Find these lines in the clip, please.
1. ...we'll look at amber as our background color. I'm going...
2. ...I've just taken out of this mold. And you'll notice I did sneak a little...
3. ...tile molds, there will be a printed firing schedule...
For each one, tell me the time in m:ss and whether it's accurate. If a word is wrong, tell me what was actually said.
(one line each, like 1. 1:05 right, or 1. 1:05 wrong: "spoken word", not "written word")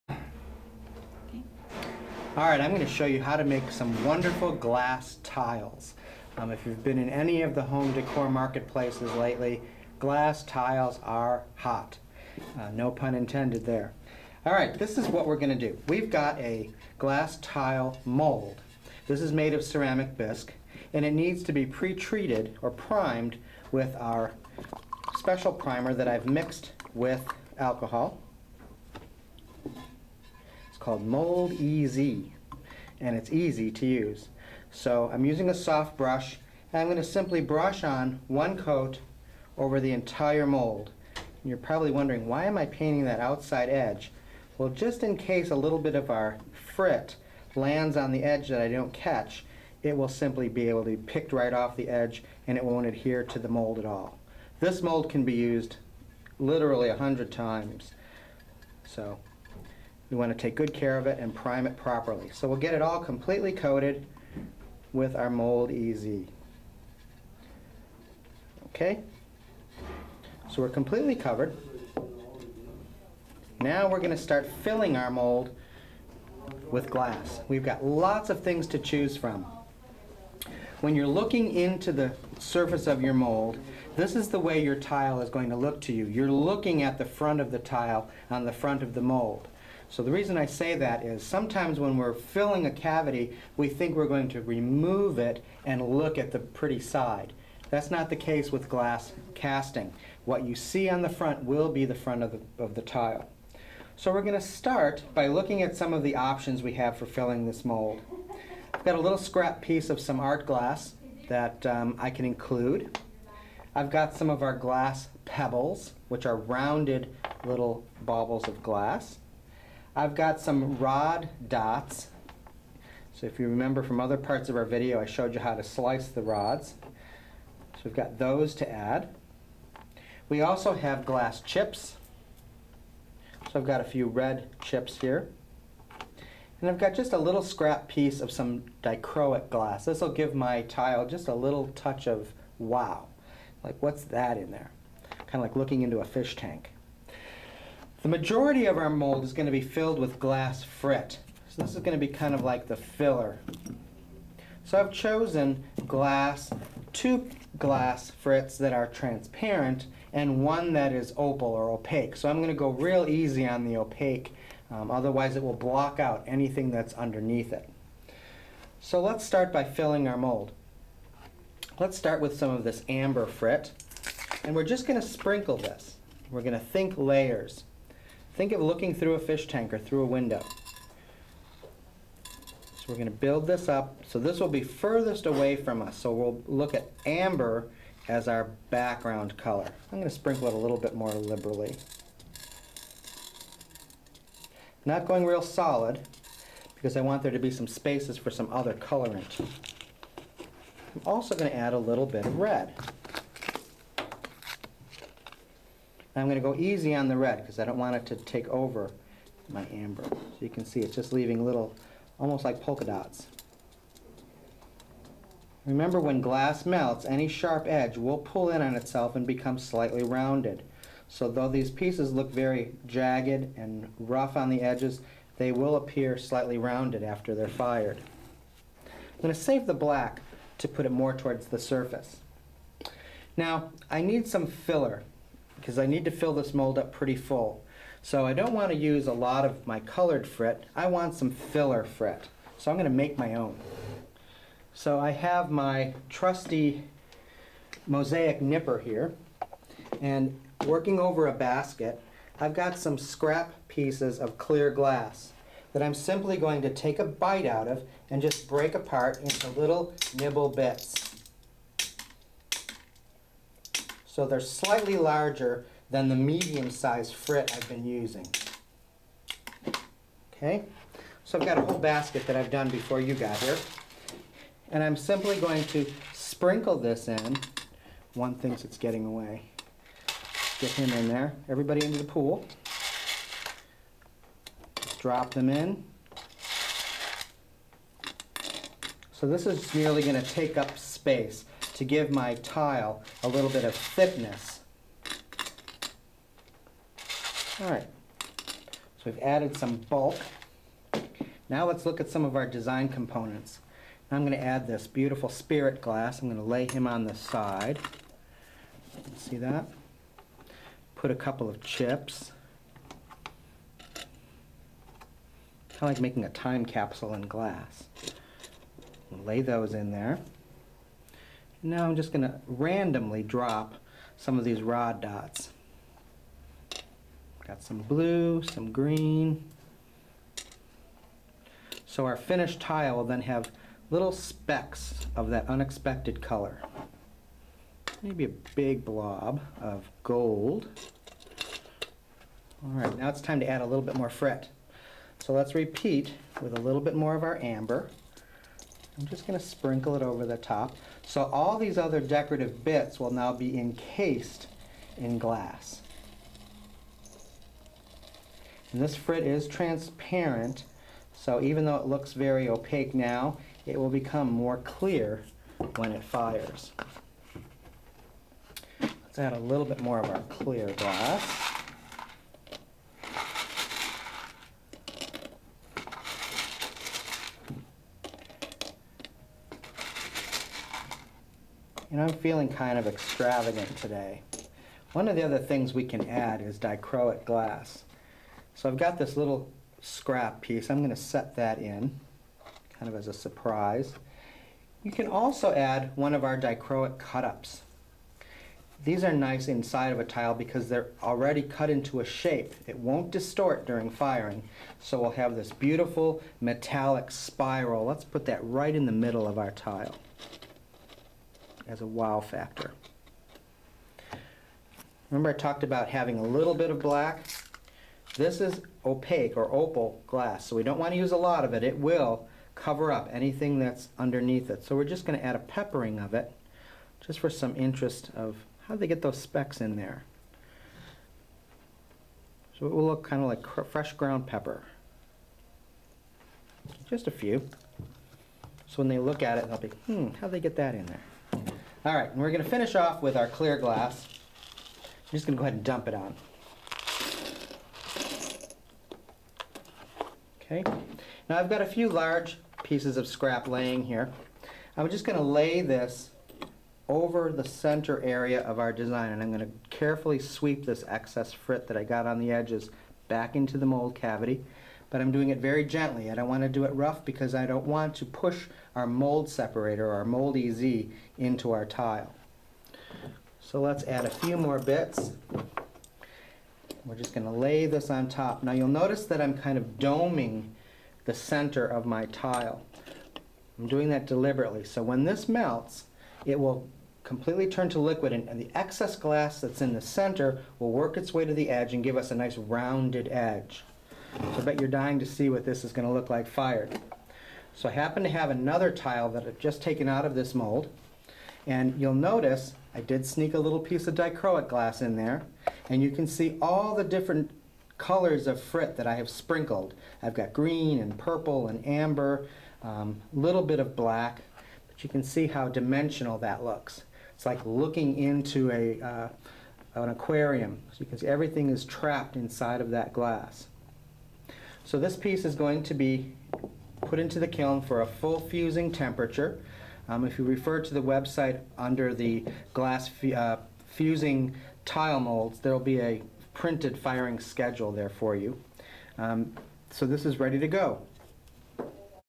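1. 3:06 right
2. 8:19 right
3. 8:54 right.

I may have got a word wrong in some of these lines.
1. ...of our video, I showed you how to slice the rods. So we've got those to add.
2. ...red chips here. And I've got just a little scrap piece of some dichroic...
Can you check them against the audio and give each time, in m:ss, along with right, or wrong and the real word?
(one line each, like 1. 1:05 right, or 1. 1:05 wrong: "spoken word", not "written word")
1. 2:04 right
2. 2:14 right.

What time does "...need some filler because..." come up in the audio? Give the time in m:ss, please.
3:54.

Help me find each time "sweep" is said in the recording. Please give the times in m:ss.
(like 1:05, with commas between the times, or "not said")
7:40.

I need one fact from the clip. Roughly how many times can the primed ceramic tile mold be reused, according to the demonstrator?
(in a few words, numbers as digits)
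100.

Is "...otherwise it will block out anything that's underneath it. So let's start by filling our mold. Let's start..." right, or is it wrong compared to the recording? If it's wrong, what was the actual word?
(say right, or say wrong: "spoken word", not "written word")
right.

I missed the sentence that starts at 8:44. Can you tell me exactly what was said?
So this piece is going to be put into the kiln for a full fusing temperature.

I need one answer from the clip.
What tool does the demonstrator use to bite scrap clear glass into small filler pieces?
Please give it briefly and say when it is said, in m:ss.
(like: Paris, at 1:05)
Mosaic nipper, at 4:07.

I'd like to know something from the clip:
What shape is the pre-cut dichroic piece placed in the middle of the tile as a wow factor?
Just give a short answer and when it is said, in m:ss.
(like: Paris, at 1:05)
Spiral, at 6:47.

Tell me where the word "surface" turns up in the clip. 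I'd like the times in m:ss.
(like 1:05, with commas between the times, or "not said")
1:22, 3:51.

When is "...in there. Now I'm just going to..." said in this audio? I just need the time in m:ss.
5:19.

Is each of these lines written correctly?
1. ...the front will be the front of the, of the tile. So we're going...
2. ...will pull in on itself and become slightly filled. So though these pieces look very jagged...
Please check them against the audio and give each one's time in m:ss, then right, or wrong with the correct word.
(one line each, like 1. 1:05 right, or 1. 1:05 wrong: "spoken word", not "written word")
1. 1:41 right
2. 3:37 wrong: "rounded", not "filled".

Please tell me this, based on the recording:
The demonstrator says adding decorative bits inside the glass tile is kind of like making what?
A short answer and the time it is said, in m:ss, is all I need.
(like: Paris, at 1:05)
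A time capsule, at 5:16.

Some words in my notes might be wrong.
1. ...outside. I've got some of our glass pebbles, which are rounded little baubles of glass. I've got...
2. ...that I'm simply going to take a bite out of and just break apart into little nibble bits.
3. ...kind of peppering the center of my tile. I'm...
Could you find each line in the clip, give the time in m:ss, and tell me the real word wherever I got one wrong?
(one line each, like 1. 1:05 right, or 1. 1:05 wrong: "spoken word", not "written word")
1. 1:52 wrong: "include", not "outside"
2. 4:15 right
3. 7:59 wrong: "doming", not "peppering".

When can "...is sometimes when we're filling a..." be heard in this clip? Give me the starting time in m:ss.
1:31.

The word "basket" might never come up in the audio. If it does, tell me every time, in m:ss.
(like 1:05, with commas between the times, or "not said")
4:11, 4:31.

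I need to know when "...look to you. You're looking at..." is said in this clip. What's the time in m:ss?
1:25.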